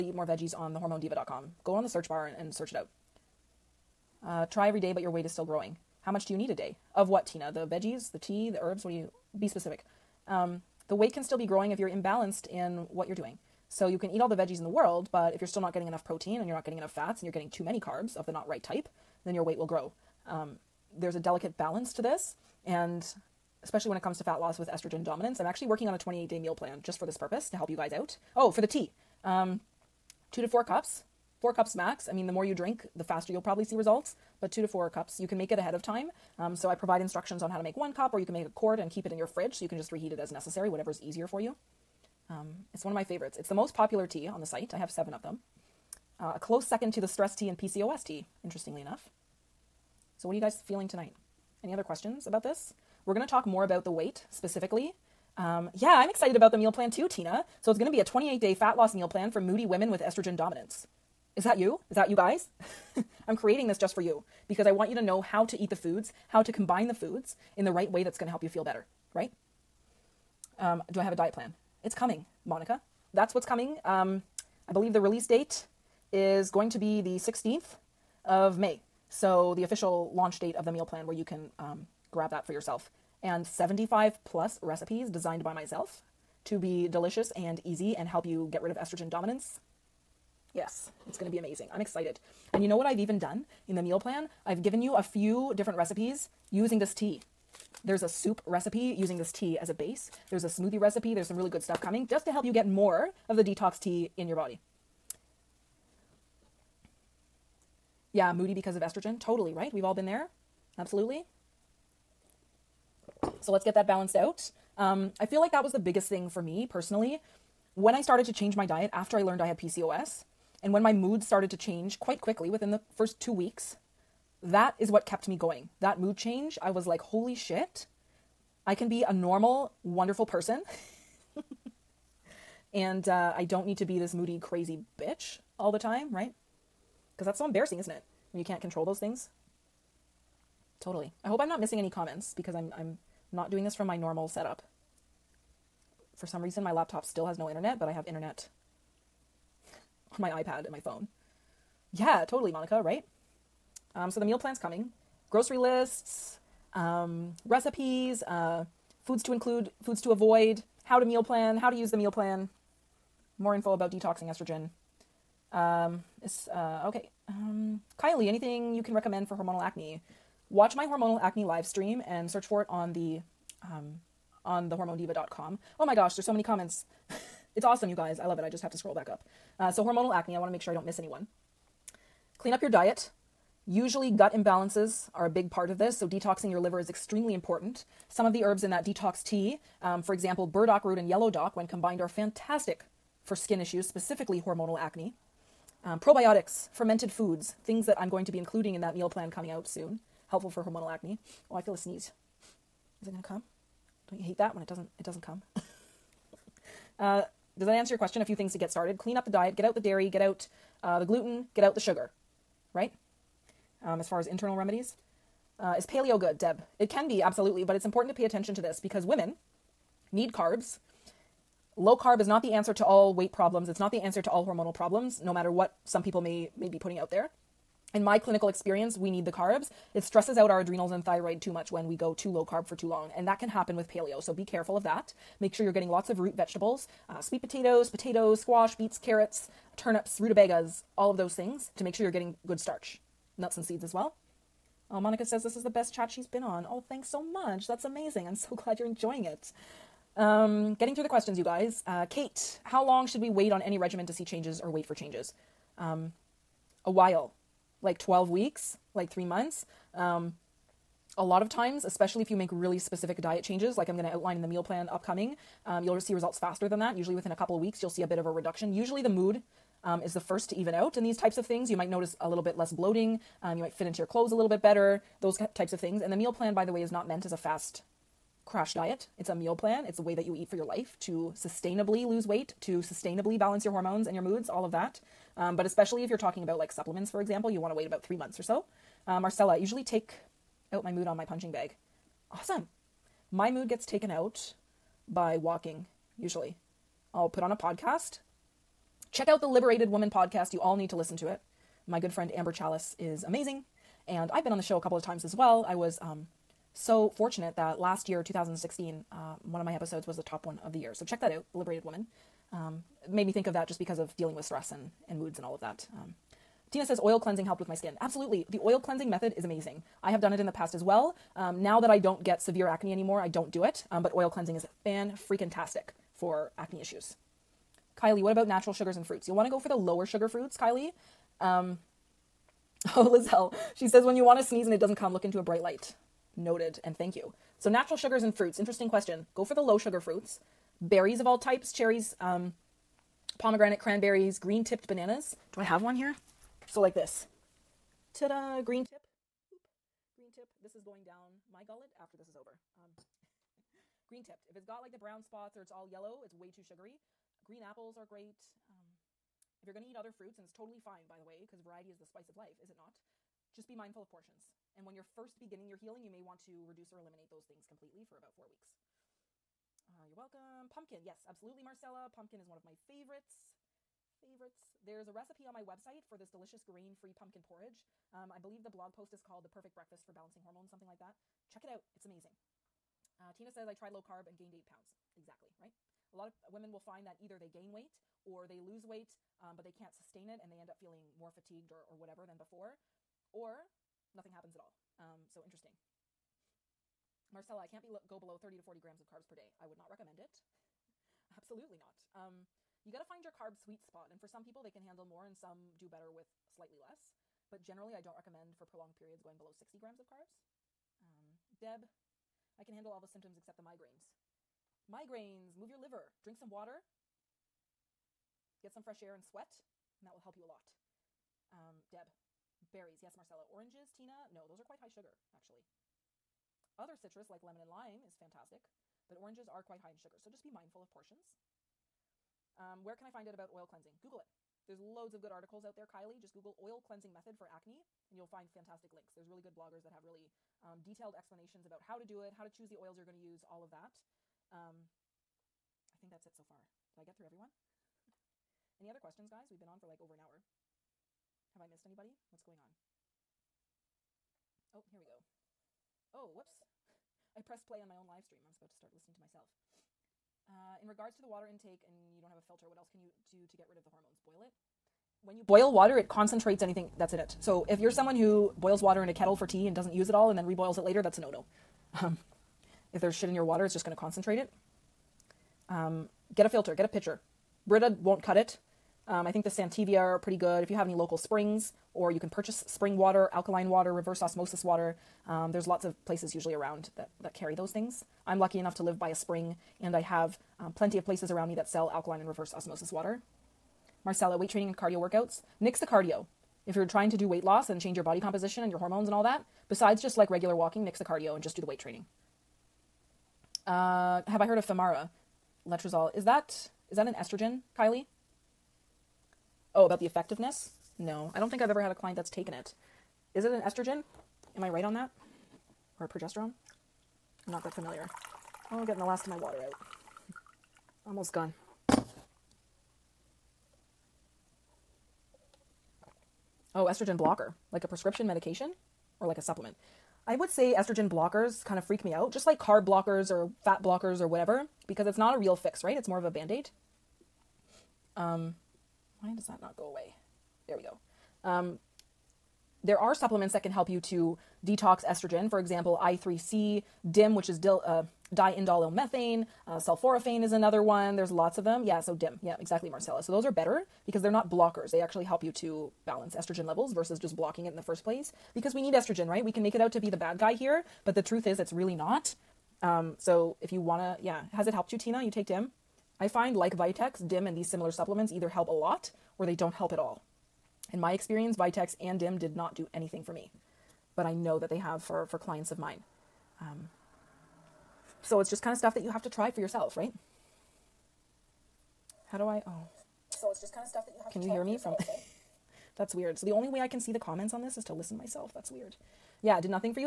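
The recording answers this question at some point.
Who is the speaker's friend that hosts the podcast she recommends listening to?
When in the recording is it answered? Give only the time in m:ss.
5:02.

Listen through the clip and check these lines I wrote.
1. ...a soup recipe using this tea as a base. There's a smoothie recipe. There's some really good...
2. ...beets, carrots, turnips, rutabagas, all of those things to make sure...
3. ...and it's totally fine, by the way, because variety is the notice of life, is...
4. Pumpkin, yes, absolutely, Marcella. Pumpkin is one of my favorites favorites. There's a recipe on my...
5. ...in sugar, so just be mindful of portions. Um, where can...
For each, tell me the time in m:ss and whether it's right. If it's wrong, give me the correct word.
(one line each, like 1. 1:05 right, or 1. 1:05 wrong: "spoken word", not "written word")
1. 1:38 right
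2. 3:58 right
3. 6:00 wrong: "spice", not "notice"
4. 6:10 right
5. 7:09 right.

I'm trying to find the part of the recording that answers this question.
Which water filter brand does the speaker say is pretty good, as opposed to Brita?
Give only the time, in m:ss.
7:59.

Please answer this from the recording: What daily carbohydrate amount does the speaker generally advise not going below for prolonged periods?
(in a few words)
60 grams.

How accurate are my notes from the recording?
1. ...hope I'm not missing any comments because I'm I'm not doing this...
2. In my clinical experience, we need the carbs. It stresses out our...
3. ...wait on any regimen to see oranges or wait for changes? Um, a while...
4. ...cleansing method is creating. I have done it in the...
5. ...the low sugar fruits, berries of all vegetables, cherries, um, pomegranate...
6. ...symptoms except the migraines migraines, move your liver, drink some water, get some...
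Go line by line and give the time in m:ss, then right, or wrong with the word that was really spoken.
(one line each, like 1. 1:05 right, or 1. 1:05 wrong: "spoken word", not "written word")
1. 2:21 right
2. 3:47 right
3. 4:13 wrong: "changes", not "oranges"
4. 5:18 wrong: "amazing", not "creating"
5. 5:39 wrong: "types", not "vegetables"
6. 6:53 right.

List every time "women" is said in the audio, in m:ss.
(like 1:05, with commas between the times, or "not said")
0:59, 3:39, 6:26.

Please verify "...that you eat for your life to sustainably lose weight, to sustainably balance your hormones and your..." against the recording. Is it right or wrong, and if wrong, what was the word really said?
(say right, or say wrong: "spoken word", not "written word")
right.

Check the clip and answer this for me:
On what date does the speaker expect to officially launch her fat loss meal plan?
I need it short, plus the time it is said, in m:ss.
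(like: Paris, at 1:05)
16th of May, at 1:17.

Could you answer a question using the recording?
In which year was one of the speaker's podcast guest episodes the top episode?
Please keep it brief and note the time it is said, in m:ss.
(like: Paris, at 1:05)
2016, at 5:08.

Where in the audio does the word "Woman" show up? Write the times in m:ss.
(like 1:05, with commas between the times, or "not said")
4:59, 5:11.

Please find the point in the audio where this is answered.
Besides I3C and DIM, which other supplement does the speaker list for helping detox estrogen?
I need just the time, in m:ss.
9:09.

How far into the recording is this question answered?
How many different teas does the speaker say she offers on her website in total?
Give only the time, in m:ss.
0:44.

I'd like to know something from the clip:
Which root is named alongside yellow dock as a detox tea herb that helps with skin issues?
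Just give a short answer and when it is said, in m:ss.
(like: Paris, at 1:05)
burdock root, at 3:10.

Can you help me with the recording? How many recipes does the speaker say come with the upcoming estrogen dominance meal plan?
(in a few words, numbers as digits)
75 plus.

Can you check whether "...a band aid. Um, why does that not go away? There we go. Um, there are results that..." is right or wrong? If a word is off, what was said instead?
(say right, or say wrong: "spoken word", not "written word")
wrong: "supplements", not "results".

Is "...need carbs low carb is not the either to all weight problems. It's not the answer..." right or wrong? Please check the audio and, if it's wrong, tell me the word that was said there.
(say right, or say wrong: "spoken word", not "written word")
wrong: "answer", not "either".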